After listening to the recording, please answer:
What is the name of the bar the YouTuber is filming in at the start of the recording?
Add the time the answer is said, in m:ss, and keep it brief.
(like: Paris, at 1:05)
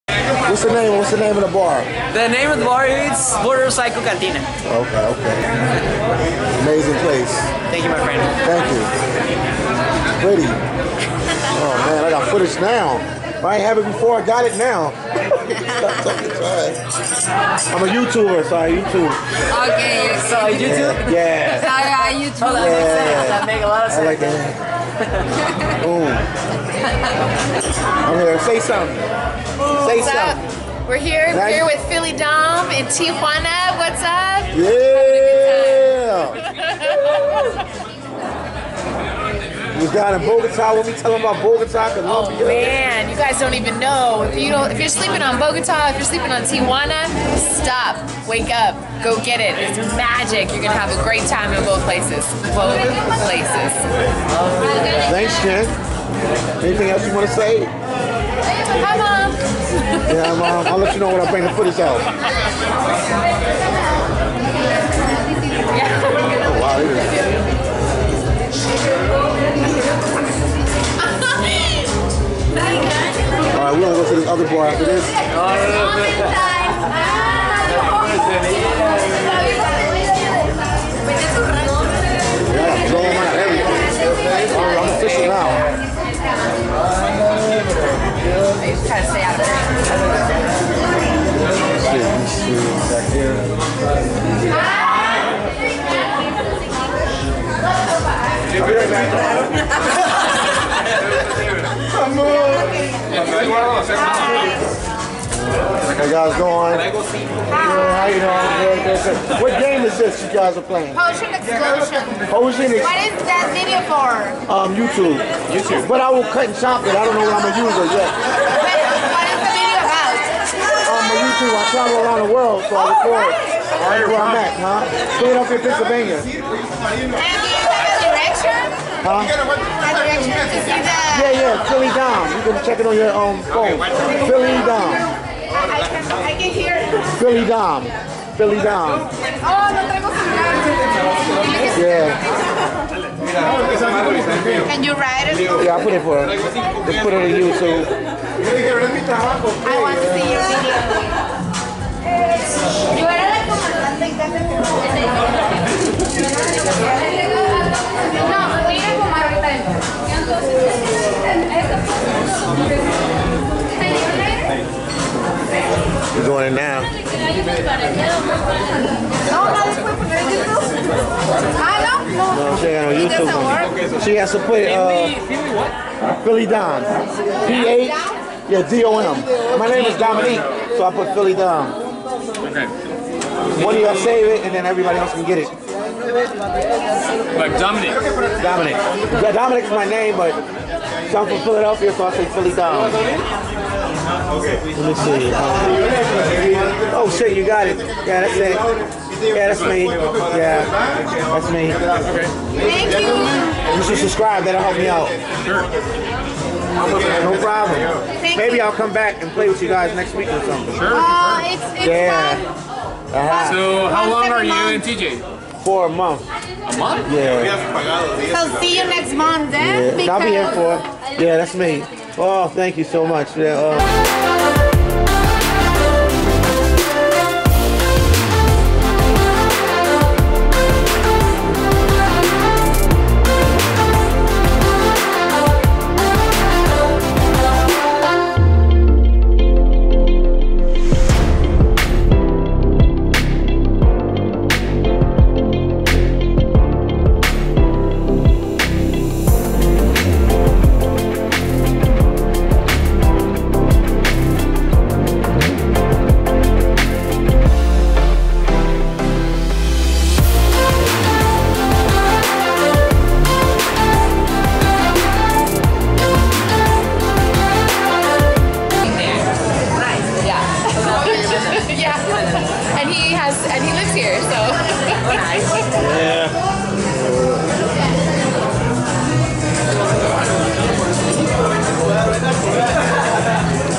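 Motorcycle Cantina, at 0:03.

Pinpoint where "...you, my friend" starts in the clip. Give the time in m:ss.
0:07.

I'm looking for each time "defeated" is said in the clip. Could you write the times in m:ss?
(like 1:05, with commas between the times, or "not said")
not said.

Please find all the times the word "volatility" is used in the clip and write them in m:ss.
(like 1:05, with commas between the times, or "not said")
not said.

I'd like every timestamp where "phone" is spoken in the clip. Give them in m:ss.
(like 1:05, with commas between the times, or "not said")
2:13.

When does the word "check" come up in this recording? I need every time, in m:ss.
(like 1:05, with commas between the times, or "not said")
2:12.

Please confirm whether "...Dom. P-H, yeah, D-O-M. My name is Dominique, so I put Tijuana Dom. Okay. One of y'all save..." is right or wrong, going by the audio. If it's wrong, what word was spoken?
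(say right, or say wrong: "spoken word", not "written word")
wrong: "Philly", not "Tijuana".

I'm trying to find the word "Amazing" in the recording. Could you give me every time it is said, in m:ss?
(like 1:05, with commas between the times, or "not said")
0:06.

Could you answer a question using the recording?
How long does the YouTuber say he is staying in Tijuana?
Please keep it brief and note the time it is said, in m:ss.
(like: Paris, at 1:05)
a month, at 3:35.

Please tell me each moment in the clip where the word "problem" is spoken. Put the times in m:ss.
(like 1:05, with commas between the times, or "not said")
3:27.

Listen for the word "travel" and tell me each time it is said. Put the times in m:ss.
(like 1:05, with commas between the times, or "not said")
2:01.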